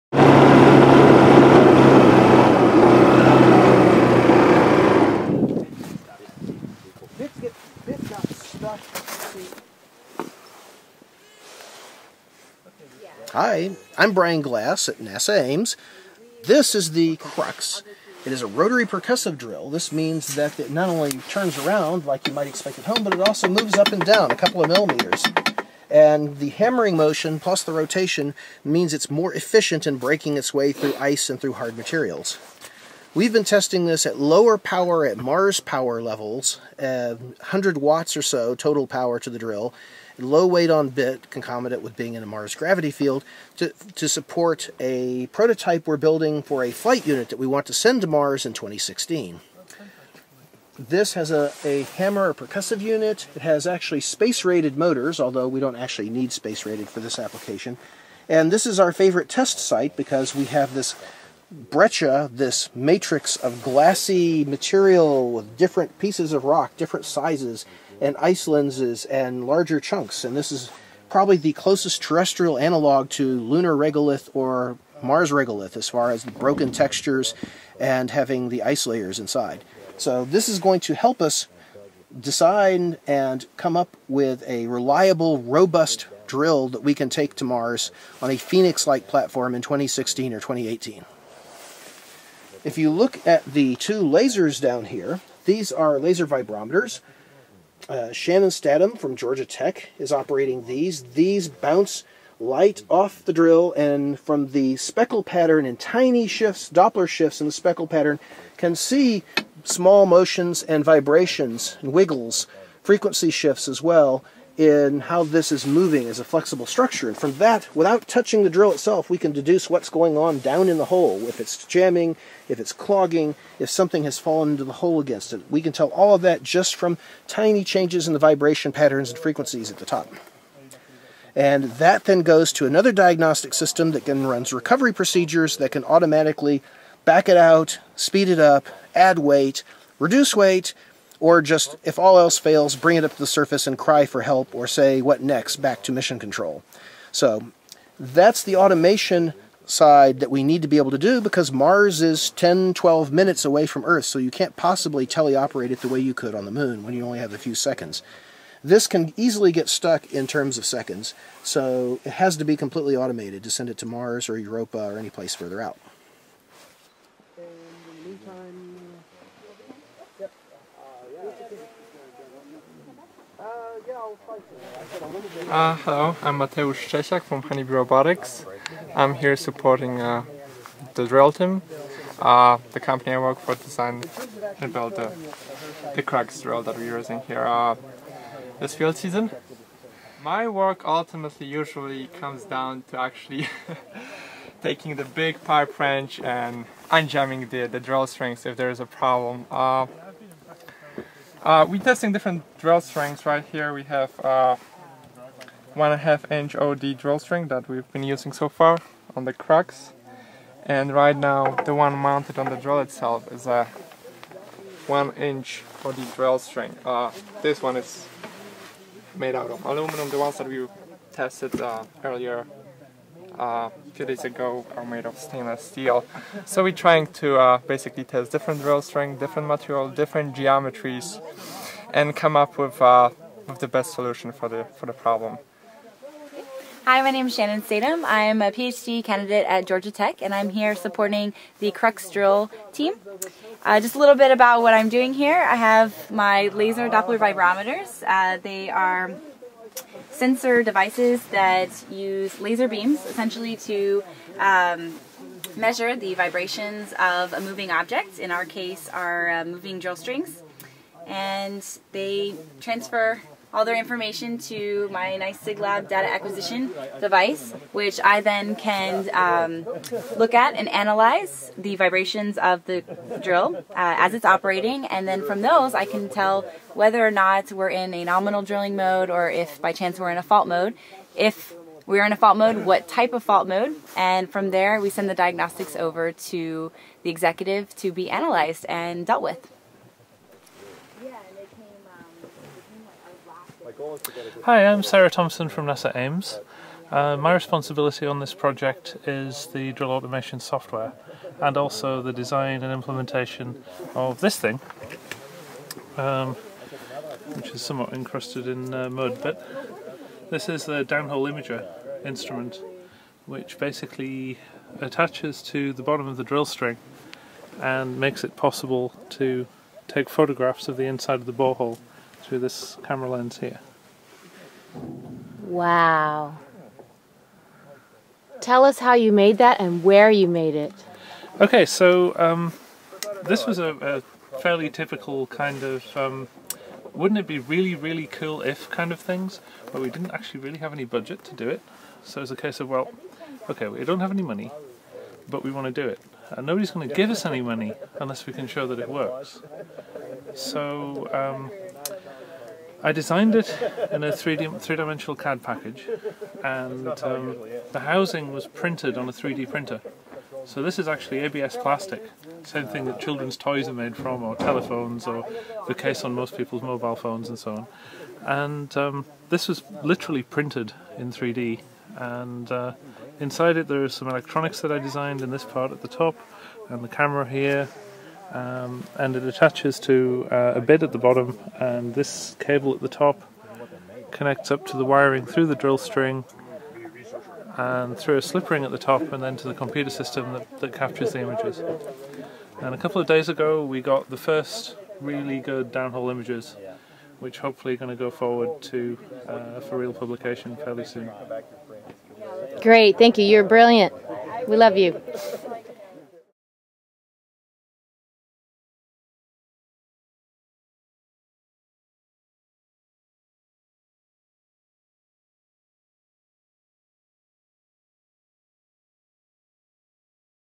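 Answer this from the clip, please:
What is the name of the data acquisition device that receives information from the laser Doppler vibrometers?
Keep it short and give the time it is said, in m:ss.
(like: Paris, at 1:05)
SIGLAB, at 4:25.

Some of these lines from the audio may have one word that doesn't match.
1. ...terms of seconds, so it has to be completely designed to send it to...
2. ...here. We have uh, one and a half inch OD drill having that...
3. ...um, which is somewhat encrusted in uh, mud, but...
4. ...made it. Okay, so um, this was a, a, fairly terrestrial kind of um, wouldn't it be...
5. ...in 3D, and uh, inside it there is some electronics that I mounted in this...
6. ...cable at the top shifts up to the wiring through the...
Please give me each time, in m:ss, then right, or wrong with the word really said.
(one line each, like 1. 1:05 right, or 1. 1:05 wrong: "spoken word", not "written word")
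1. 2:40 wrong: "automated", not "designed"
2. 3:23 wrong: "string", not "having"
3. 5:05 right
4. 5:30 wrong: "typical", not "terrestrial"
5. 6:10 wrong: "designed", not "mounted"
6. 6:22 wrong: "connects", not "shifts".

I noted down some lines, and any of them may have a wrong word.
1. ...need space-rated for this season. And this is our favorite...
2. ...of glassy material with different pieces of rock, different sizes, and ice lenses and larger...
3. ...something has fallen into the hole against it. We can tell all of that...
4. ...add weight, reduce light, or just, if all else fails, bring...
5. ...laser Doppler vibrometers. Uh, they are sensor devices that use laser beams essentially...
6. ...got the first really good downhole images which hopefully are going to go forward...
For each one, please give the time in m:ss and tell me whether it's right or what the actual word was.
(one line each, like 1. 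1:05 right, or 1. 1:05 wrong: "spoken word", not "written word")
1. 0:56 wrong: "application", not "season"
2. 1:03 right
3. 2:03 right
4. 2:18 wrong: "weight", not "light"
5. 4:06 right
6. 6:33 right.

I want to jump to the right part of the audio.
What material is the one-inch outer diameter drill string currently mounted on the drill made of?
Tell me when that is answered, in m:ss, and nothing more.
3:39.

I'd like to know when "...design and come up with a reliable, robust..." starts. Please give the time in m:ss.
1:22.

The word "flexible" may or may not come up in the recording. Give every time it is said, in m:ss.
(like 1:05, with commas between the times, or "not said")
1:56.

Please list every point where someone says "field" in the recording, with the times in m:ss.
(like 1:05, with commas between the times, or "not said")
0:42, 3:08.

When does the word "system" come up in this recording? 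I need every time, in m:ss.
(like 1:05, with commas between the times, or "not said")
2:13, 6:29.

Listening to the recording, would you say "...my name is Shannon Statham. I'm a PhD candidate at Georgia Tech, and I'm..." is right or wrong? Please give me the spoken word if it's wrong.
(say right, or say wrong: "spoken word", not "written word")
right.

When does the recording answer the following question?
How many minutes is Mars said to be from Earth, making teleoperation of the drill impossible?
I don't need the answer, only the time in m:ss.
2:32.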